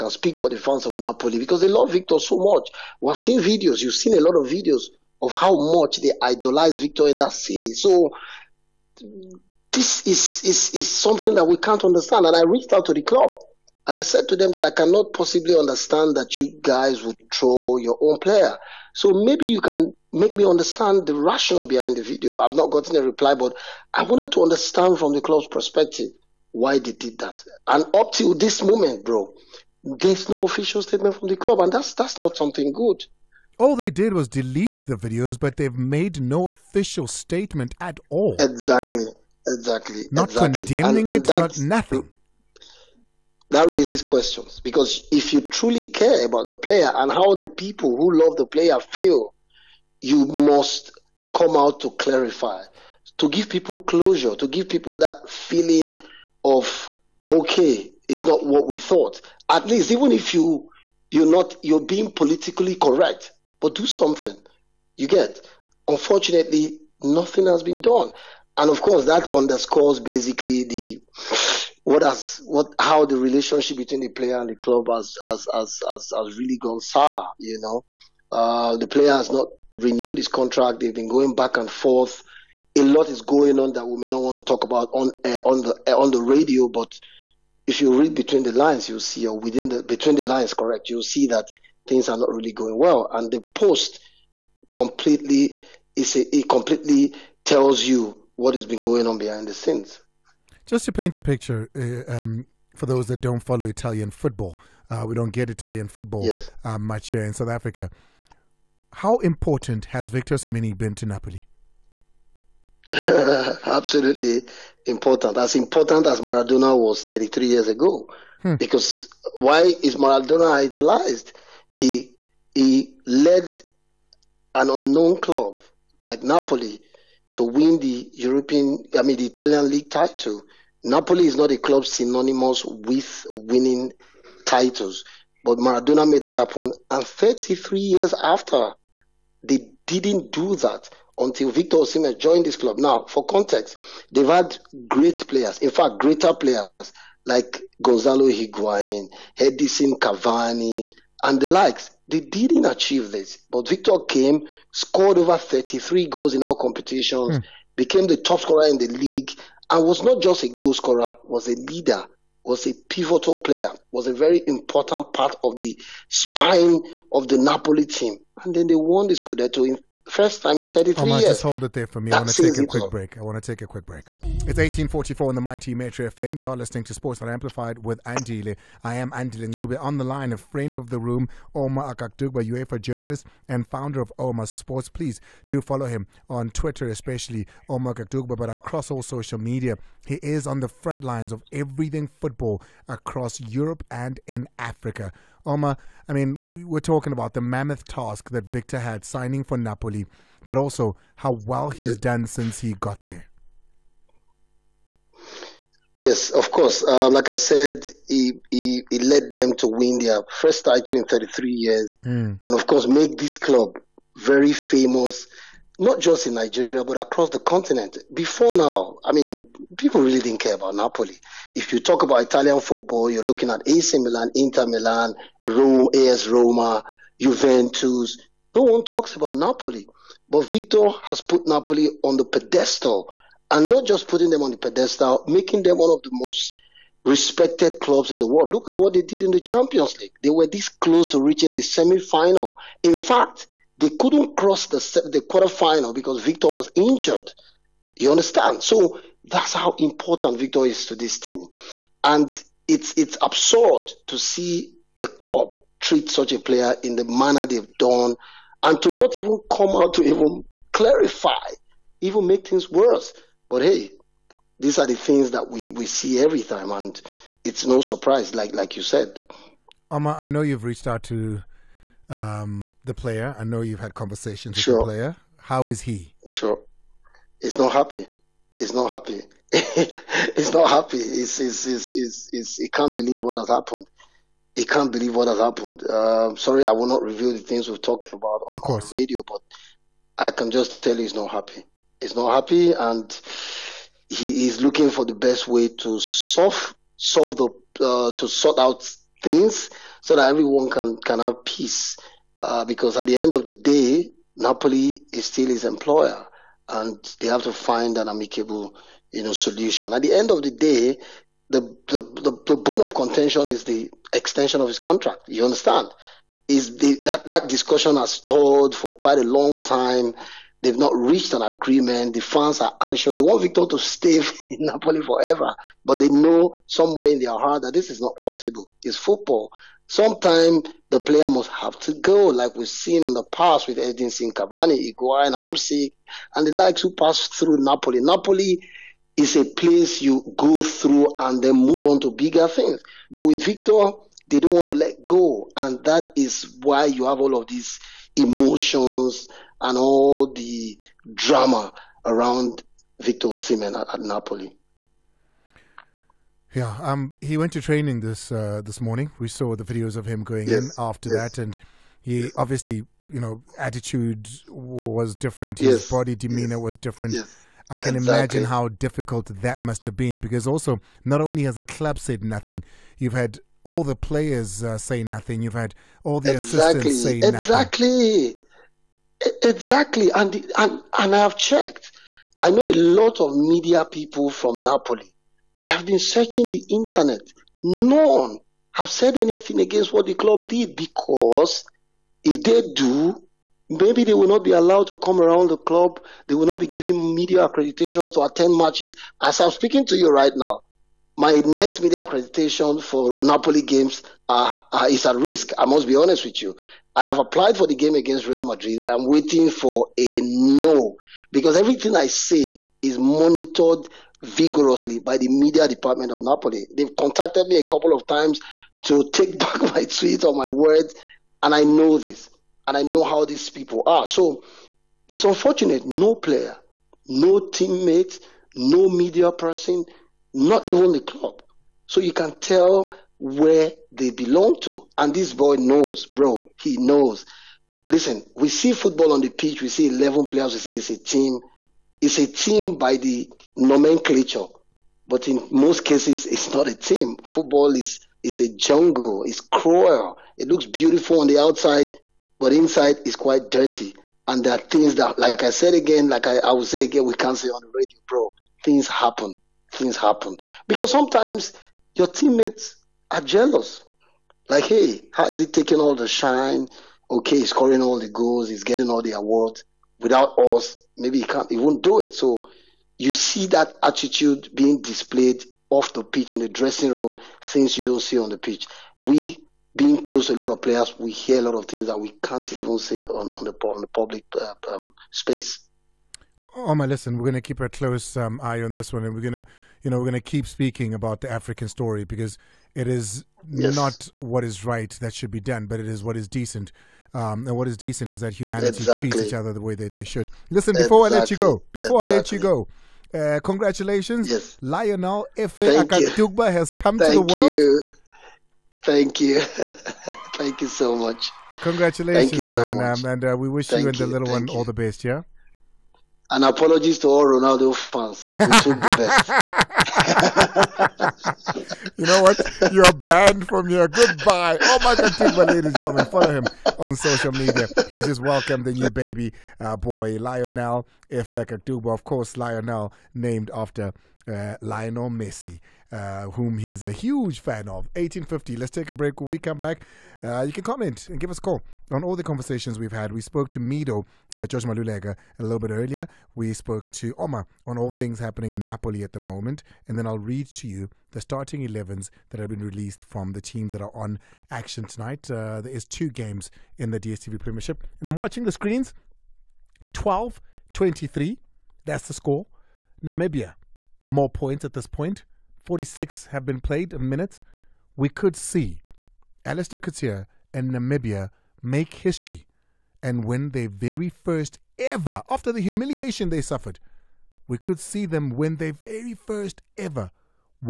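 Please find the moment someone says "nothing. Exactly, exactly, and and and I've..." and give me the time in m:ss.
6:17.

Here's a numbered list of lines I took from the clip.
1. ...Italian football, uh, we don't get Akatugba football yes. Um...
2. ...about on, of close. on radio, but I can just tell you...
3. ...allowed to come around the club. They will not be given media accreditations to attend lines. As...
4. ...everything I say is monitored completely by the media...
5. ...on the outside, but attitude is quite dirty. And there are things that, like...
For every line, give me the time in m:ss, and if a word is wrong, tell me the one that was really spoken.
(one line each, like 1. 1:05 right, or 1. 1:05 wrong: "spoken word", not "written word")
1. 1:43 wrong: "Italian", not "Akatugba"
2. 4:48 wrong: "course", not "close"
3. 6:34 wrong: "matches", not "lines"
4. 6:51 wrong: "vigorously", not "completely"
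5. 7:31 wrong: "inside", not "attitude".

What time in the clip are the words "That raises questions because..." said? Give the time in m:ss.
0:43.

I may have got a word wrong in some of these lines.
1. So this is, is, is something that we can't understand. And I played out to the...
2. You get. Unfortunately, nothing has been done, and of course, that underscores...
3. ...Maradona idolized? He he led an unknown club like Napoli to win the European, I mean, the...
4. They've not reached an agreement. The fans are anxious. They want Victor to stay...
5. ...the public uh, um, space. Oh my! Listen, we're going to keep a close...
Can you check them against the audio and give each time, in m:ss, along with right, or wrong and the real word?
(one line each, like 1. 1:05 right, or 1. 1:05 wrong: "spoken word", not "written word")
1. 0:07 wrong: "reached", not "played"
2. 1:04 right
3. 1:59 right
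4. 5:20 right
5. 8:03 right.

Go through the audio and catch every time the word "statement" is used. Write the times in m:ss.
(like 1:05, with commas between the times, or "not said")
0:30, 0:37.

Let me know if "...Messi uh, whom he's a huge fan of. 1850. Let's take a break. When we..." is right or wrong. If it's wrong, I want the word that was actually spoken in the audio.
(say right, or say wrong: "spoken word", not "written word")
right.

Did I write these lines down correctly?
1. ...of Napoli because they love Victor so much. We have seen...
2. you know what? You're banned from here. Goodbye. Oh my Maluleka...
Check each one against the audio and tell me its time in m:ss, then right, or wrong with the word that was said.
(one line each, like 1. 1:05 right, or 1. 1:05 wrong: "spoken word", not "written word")
1. 0:00 right
2. 8:41 wrong: "God", not "Maluleka".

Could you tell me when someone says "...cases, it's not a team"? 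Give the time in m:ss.
7:25.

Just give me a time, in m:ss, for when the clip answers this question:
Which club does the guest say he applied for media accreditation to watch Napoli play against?
6:47.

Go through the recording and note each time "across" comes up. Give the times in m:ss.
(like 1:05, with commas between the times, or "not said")
3:08, 3:12, 3:36.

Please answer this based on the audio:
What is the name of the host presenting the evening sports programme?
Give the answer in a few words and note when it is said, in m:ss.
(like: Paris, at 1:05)
Andile Ncube, at 2:58.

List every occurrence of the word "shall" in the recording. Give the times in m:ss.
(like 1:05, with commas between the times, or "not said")
not said.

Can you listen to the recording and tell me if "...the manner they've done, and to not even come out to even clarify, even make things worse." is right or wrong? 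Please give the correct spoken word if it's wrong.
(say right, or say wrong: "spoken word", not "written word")
right.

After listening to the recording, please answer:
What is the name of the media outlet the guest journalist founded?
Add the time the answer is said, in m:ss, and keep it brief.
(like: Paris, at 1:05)
Oma Sports, at 3:03.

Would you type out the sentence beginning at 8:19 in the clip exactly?
treats each other the way that they should.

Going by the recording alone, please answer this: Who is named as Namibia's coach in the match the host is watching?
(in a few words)
Allister Coetzee.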